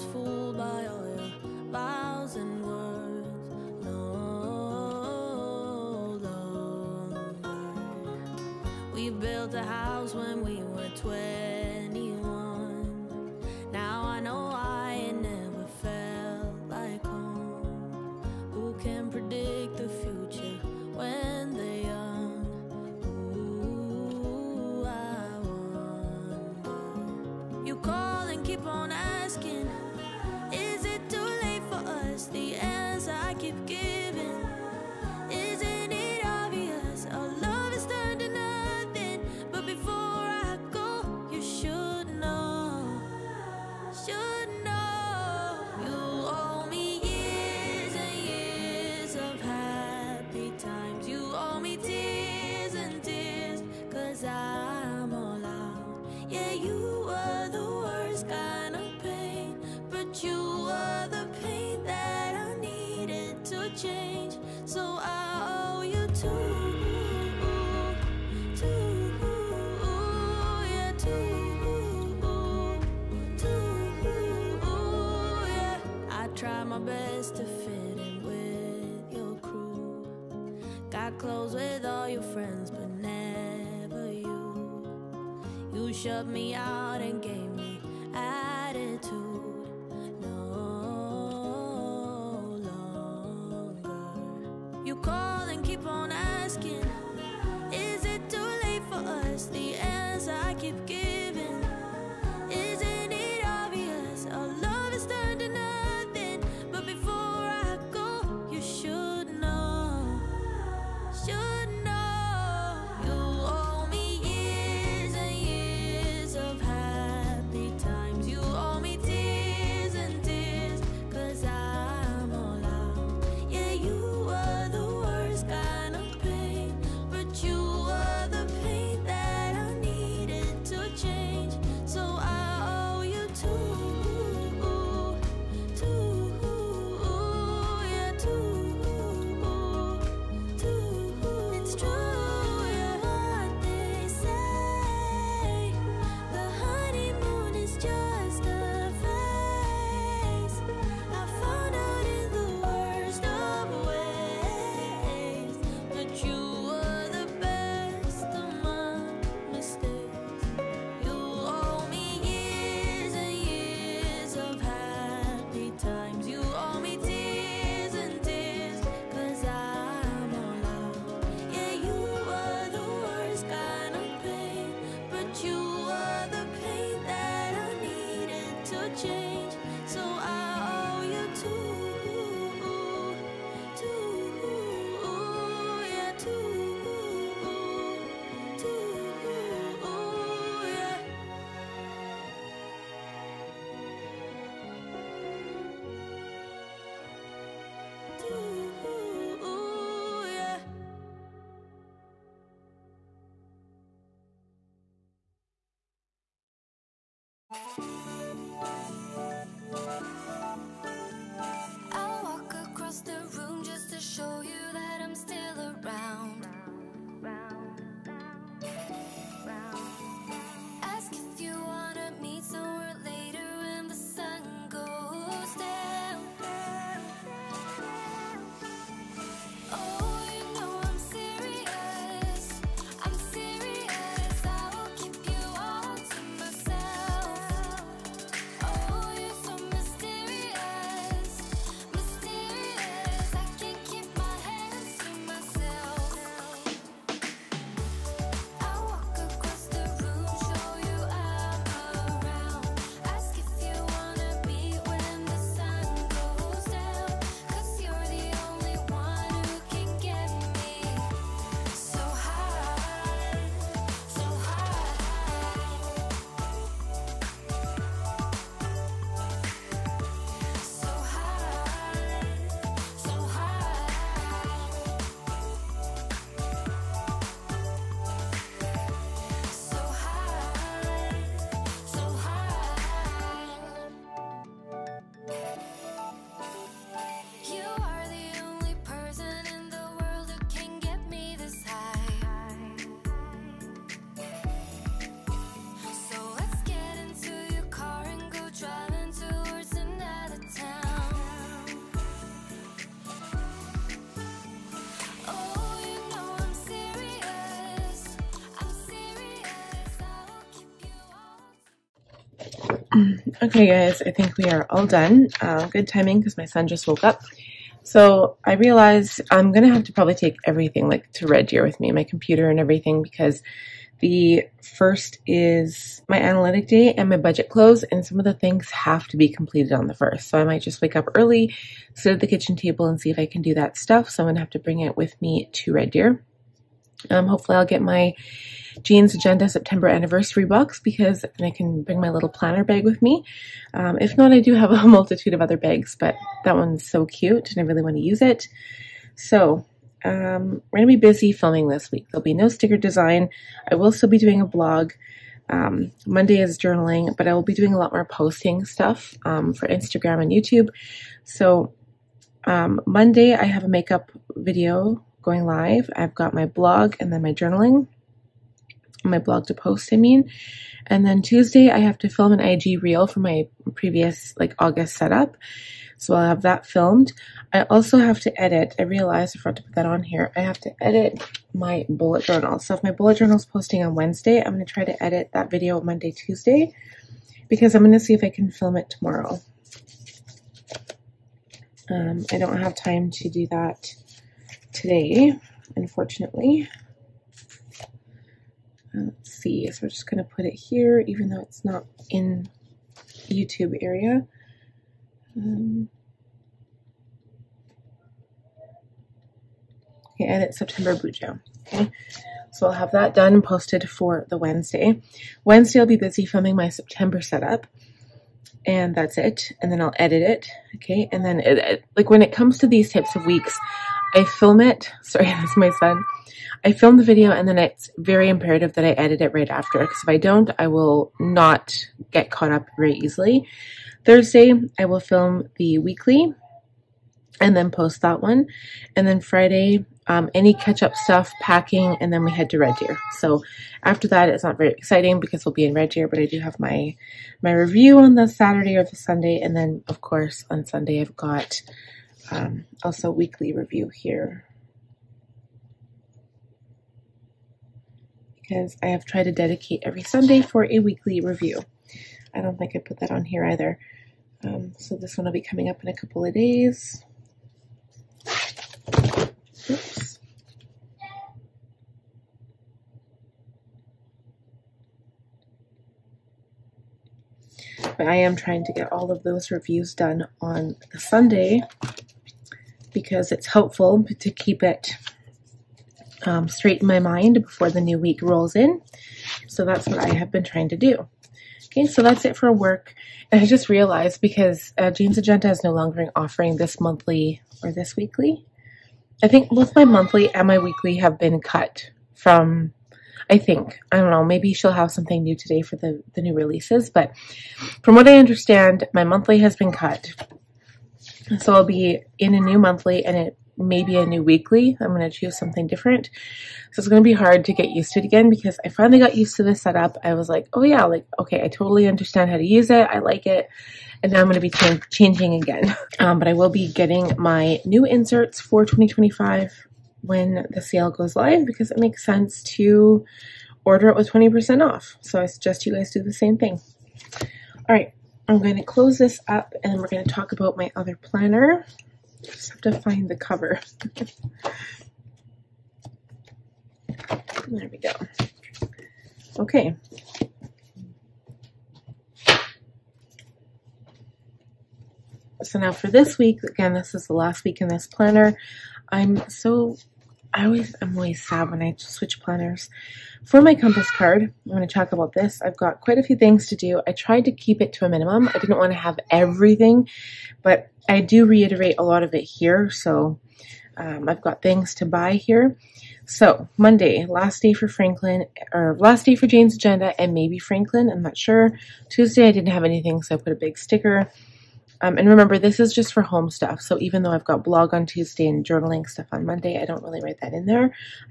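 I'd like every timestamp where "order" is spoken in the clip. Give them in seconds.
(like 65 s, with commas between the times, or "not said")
533 s.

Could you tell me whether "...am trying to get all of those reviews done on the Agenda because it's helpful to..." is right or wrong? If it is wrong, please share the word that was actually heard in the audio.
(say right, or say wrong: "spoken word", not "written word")
wrong: "Sunday", not "Agenda".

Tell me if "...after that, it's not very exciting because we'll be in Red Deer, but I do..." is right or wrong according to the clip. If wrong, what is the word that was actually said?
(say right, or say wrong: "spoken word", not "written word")
right.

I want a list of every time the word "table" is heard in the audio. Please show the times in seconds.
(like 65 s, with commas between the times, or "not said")
332 s.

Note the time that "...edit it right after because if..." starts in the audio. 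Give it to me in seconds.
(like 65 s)
428 s.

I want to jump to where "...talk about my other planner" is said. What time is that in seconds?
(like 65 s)
540 s.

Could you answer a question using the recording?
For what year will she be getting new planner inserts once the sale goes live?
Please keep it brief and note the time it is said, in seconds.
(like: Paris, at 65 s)
2025, at 528 s.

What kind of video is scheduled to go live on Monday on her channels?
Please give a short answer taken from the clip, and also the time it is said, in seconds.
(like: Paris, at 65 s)
makeup video, at 363 s.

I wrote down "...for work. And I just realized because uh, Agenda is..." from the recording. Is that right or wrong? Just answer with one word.
right.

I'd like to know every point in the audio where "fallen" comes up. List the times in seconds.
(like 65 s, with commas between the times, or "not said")
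not said.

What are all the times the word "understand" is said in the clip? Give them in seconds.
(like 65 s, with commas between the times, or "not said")
508 s, 521 s.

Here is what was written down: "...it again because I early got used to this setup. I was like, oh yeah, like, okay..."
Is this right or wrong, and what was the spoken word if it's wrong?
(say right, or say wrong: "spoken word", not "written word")
wrong: "finally", not "early".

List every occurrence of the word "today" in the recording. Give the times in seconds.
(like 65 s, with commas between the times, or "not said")
394 s, 505 s.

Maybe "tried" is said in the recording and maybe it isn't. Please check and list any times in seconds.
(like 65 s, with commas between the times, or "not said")
459 s, 566 s.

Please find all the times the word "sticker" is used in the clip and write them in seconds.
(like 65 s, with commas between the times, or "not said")
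352 s, 583 s.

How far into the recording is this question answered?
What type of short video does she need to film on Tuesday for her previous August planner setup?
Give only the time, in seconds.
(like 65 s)
372 s.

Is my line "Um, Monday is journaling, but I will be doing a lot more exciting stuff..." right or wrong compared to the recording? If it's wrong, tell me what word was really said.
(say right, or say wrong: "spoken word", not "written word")
wrong: "posting", not "exciting".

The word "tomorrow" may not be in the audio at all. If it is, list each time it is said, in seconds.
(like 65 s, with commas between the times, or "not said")
388 s.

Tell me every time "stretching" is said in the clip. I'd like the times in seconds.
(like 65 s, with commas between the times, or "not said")
not said.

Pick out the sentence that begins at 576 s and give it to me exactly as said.
So Monday, last day for Franklin, or last day for Jane's agenda, and maybe Franklin.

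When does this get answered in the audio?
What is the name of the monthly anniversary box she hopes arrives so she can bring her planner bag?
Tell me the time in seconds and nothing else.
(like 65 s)
338 s.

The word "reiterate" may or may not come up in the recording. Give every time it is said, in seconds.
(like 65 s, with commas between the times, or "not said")
571 s.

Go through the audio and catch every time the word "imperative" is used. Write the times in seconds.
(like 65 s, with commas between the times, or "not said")
428 s.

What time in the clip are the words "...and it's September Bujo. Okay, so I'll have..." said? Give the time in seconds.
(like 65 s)
410 s.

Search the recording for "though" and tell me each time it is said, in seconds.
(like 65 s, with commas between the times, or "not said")
401 s, 587 s.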